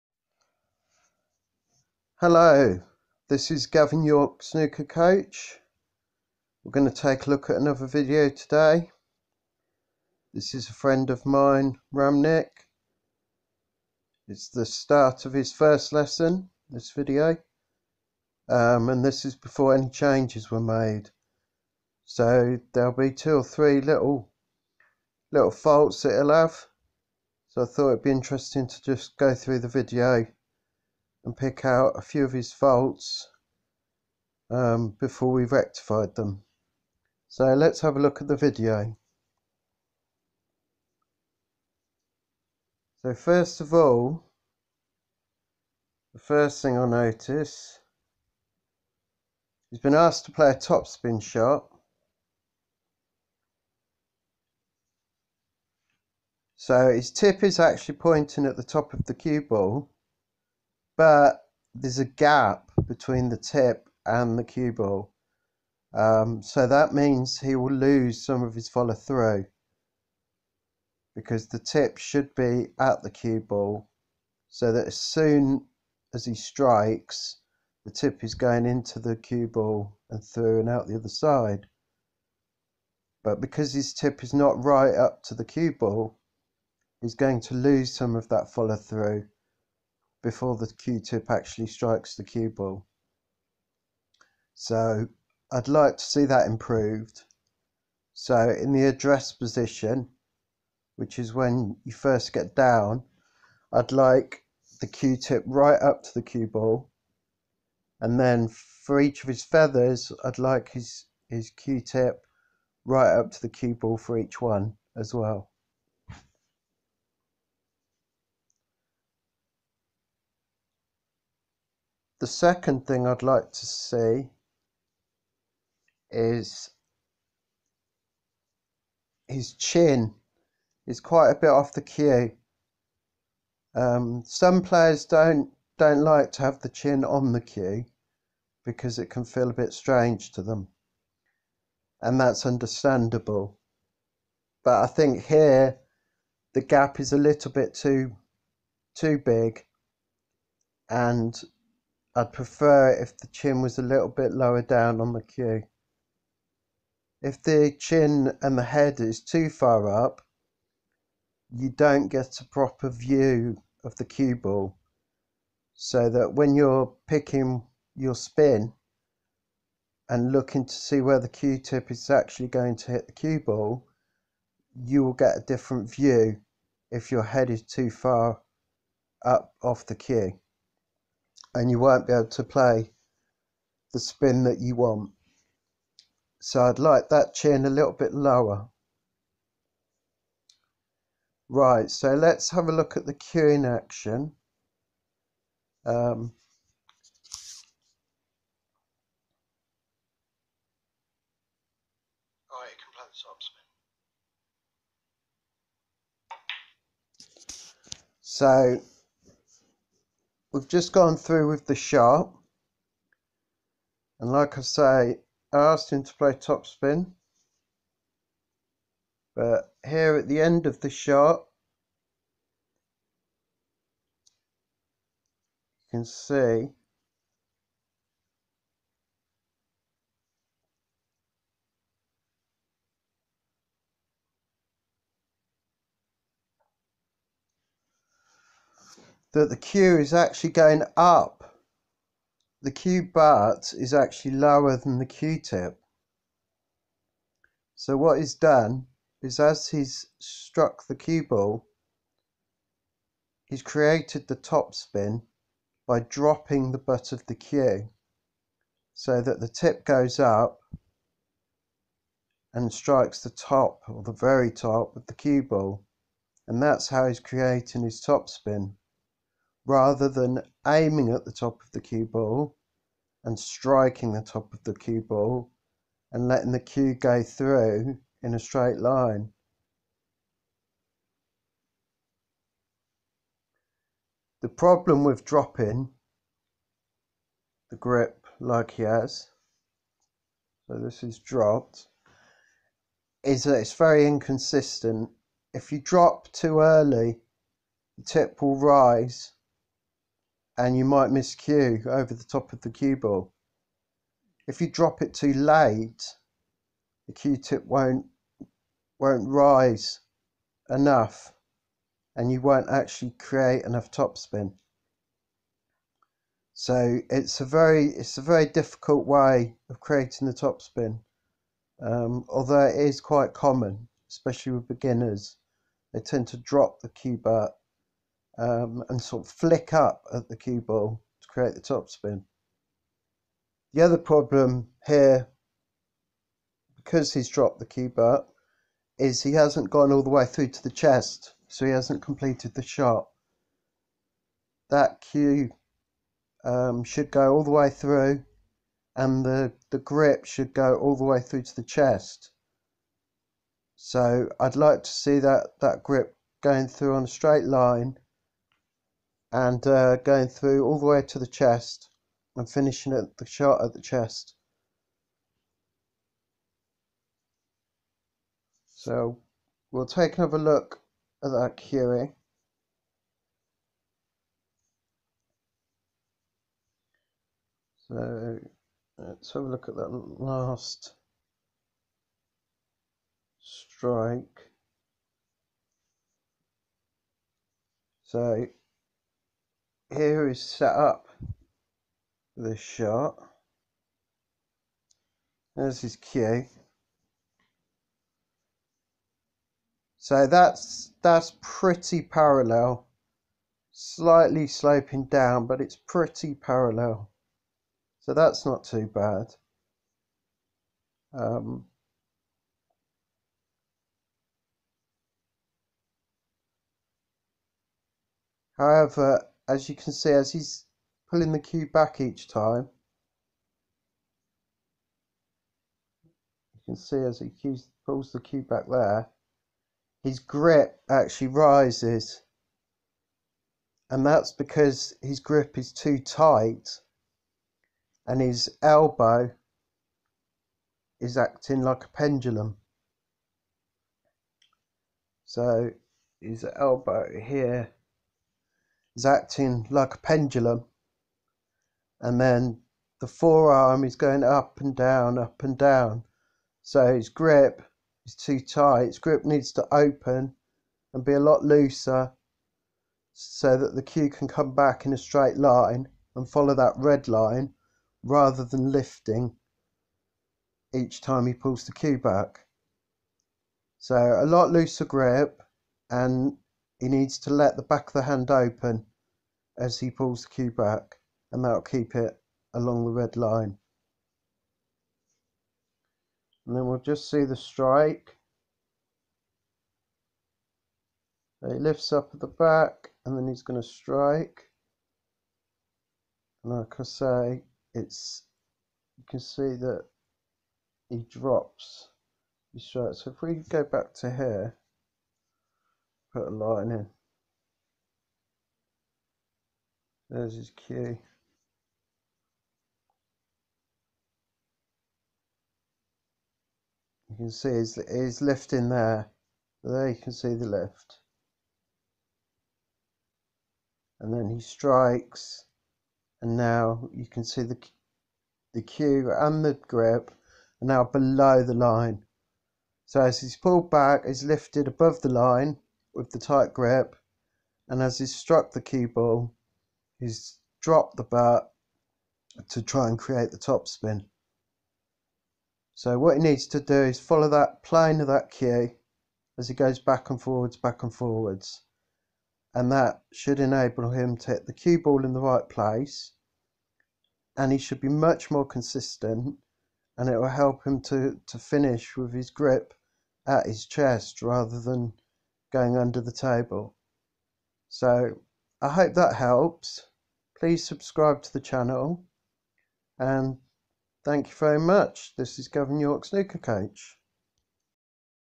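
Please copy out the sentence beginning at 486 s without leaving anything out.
And then we'll just see the strike.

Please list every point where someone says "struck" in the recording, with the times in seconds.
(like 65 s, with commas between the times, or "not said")
250 s, 538 s.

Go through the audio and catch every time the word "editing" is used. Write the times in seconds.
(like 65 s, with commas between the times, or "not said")
not said.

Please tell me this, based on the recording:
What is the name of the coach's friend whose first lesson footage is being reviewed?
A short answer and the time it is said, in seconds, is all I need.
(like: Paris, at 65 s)
Ramnik, at 11 s.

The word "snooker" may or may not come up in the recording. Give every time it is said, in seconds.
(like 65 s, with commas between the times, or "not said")
4 s, 576 s.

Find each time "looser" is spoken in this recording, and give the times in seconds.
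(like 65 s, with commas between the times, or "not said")
461 s, 474 s.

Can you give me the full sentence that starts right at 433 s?
And that's because his grip is too tight and his elbow is acting like a pendulum.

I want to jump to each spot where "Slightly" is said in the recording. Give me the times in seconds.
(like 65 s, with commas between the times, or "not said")
403 s.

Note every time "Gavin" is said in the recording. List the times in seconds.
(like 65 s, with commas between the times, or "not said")
3 s, 575 s.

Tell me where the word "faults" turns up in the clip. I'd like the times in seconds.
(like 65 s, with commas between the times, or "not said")
25 s, 32 s.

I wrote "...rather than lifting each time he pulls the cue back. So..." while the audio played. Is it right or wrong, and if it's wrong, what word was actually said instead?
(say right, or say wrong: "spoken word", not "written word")
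right.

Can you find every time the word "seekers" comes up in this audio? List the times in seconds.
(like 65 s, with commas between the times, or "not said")
not said.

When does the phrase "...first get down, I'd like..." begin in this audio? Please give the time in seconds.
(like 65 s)
101 s.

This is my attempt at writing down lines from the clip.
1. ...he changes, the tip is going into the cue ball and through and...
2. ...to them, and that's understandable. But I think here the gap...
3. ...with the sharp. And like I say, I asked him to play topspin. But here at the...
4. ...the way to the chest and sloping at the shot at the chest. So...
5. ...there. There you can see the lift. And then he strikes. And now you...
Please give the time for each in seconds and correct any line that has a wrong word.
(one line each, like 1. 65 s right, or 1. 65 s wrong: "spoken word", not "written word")
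1. 76 s wrong: "strikes", not "changes"
2. 140 s right
3. 211 s right
4. 360 s wrong: "finishing", not "sloping"
5. 518 s right.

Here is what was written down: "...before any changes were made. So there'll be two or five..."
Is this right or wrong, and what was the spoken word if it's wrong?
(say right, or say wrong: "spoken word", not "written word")
wrong: "three", not "five".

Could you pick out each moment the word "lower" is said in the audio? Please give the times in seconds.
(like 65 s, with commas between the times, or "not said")
154 s, 188 s, 244 s.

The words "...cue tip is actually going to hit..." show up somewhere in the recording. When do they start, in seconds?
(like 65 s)
171 s.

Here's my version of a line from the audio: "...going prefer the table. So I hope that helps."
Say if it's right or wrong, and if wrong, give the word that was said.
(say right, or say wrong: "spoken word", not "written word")
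wrong: "under", not "prefer".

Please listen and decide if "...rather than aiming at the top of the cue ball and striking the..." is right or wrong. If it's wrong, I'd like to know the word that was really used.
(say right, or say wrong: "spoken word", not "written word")
right.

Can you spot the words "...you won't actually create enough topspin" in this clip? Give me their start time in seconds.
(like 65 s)
312 s.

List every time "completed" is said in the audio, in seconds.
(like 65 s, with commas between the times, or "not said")
342 s.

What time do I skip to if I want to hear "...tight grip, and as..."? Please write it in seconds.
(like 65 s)
536 s.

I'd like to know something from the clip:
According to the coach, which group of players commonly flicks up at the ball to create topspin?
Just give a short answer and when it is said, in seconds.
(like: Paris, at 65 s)
beginners, at 324 s.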